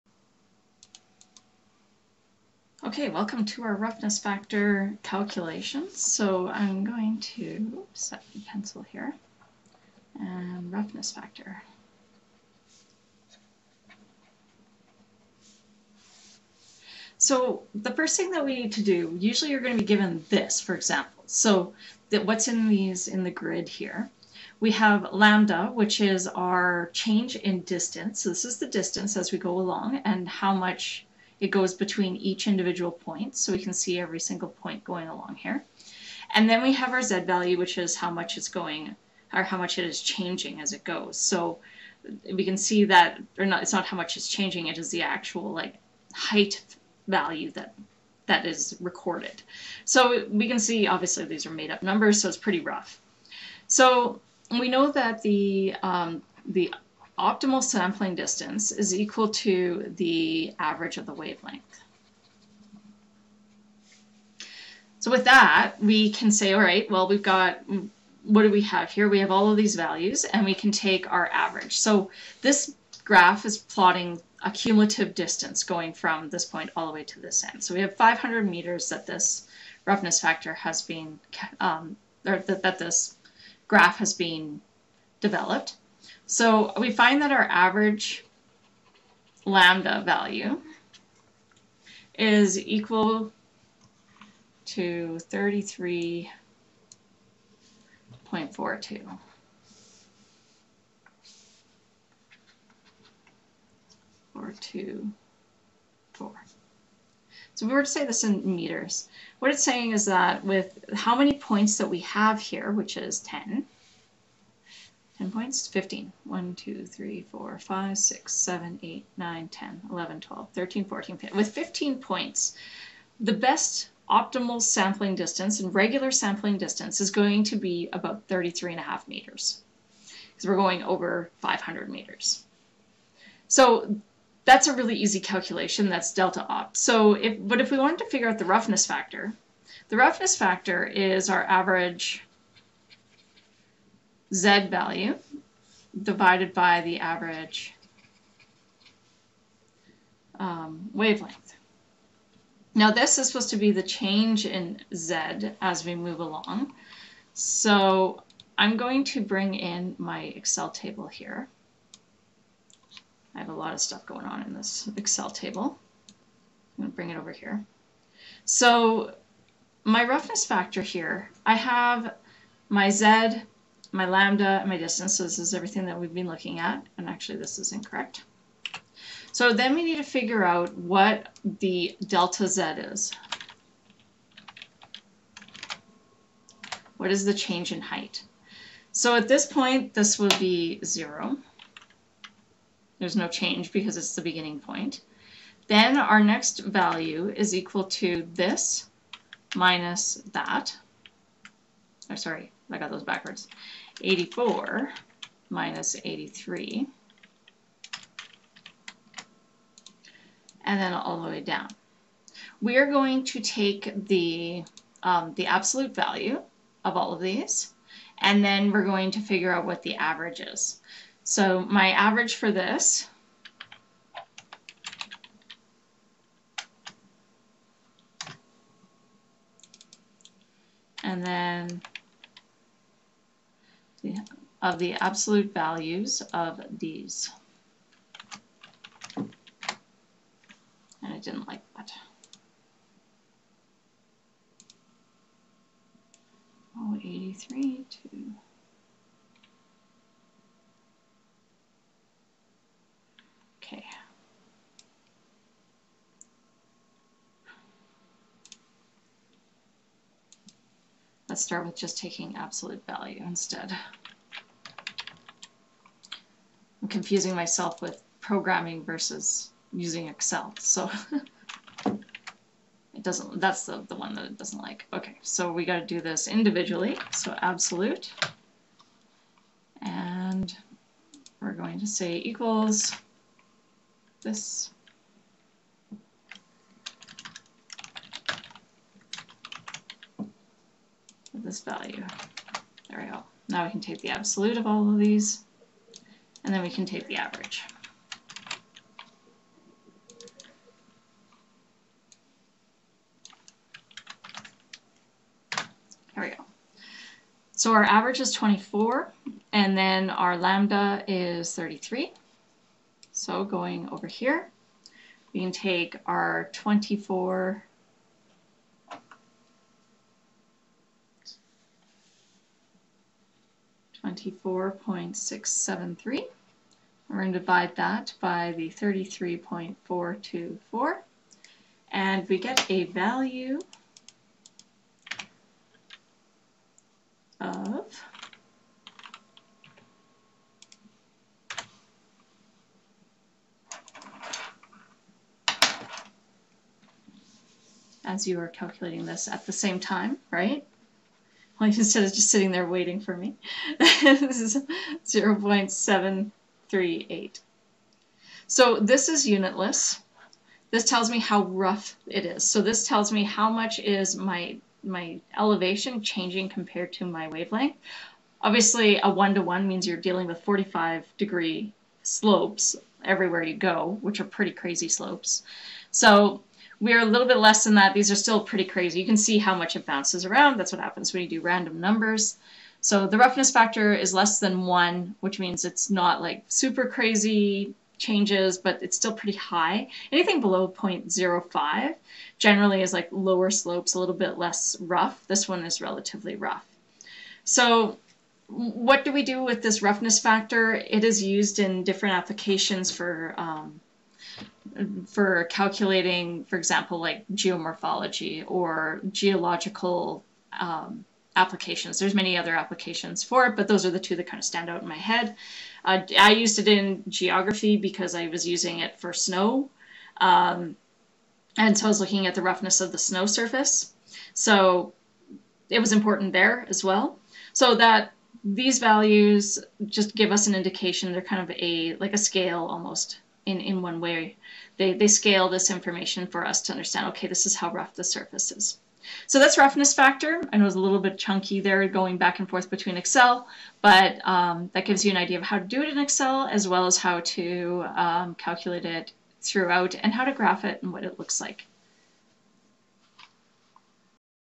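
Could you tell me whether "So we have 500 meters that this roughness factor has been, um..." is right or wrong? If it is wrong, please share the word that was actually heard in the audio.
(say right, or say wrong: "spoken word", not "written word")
right.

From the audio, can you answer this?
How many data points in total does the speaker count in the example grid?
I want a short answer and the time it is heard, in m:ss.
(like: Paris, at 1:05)
15, at 2:01.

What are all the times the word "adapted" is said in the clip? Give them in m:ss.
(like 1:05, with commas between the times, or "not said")
not said.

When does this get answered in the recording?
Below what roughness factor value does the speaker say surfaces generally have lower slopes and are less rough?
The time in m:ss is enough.
6:30.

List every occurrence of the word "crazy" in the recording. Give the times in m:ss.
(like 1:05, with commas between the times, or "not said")
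6:14, 6:18, 6:26.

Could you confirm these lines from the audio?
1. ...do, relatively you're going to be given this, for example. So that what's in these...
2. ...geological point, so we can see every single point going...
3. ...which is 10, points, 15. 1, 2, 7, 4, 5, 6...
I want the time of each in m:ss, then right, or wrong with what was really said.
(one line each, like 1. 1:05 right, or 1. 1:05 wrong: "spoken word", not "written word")
1. 0:18 wrong: "usually", not "relatively"
2. 0:32 wrong: "individual", not "geological"
3. 1:52 wrong: "3", not "7".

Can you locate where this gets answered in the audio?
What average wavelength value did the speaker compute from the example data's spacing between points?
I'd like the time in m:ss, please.
1:35.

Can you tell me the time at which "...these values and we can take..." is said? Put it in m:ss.
1:09.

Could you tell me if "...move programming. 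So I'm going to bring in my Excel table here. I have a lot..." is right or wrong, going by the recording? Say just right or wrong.
wrong.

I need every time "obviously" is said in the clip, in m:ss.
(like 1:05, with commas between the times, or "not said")
0:50, 6:08.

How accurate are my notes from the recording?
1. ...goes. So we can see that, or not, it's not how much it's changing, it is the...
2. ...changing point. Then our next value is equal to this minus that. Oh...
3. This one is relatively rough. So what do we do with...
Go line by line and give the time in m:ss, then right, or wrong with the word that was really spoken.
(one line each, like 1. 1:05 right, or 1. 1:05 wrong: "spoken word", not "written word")
1. 0:40 right
2. 3:14 wrong: "beginning", not "changing"
3. 6:35 right.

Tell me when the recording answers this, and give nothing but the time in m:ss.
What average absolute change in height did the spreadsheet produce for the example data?
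5:24.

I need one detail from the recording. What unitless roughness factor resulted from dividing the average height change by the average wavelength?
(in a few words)
0.738.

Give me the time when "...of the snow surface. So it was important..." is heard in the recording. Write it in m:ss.
7:02.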